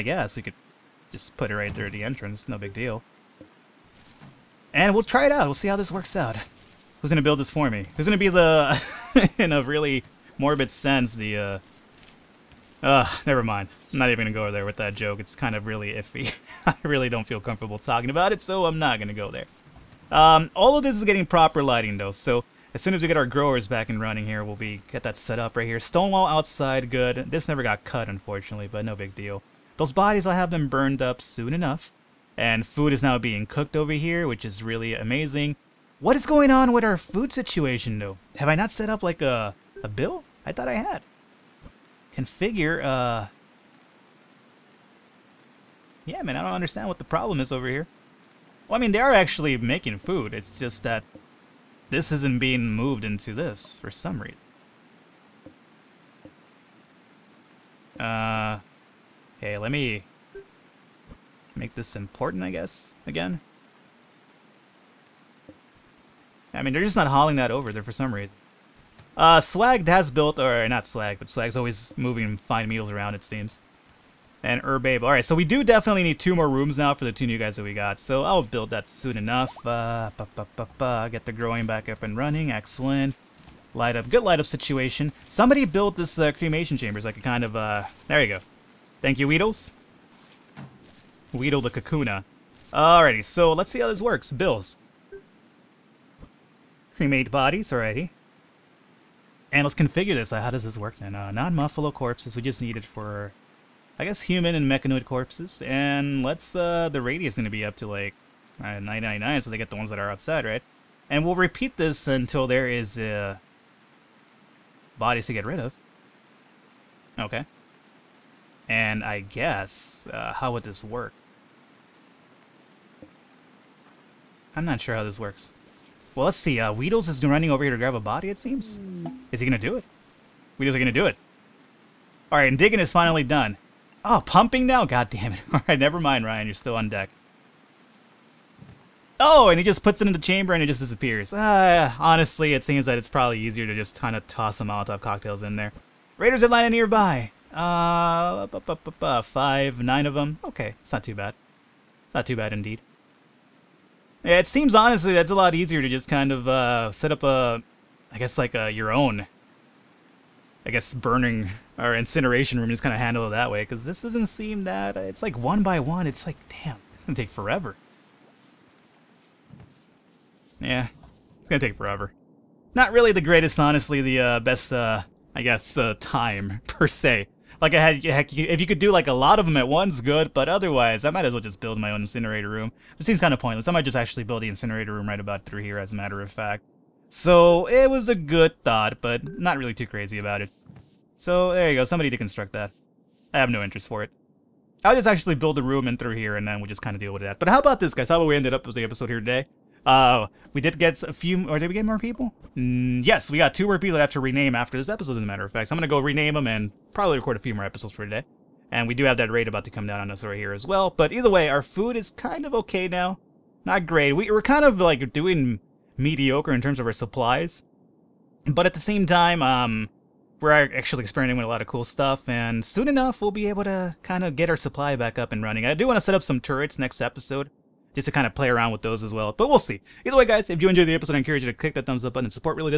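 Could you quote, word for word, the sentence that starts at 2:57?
Like I had, heck, if you could do like a lot of them at once, good.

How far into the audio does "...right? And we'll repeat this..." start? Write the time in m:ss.
1:50.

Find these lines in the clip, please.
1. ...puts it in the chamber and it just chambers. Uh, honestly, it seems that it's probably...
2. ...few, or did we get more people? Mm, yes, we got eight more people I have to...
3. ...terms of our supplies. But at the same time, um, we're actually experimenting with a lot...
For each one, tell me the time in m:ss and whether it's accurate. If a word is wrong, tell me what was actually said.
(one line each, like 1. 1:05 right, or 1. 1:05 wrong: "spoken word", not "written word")
1. 2:19 wrong: "disappears", not "chambers"
2. 3:21 wrong: "two", not "eight"
3. 3:36 right.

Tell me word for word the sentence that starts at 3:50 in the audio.
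Either way, guys, if you enjoyed the episode, I encourage you to click that thumbs up button.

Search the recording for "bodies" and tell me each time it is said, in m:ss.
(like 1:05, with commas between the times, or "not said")
0:29, 1:37, 1:54.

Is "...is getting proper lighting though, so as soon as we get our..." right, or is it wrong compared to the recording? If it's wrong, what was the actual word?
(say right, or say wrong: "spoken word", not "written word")
right.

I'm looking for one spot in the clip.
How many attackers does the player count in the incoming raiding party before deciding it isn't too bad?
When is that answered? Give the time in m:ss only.
2:29.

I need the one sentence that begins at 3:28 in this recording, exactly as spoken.
And we do have that raid about to come down on us right here as well.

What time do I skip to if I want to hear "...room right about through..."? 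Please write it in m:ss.
3:04.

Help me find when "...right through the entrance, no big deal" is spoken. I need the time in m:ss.
0:01.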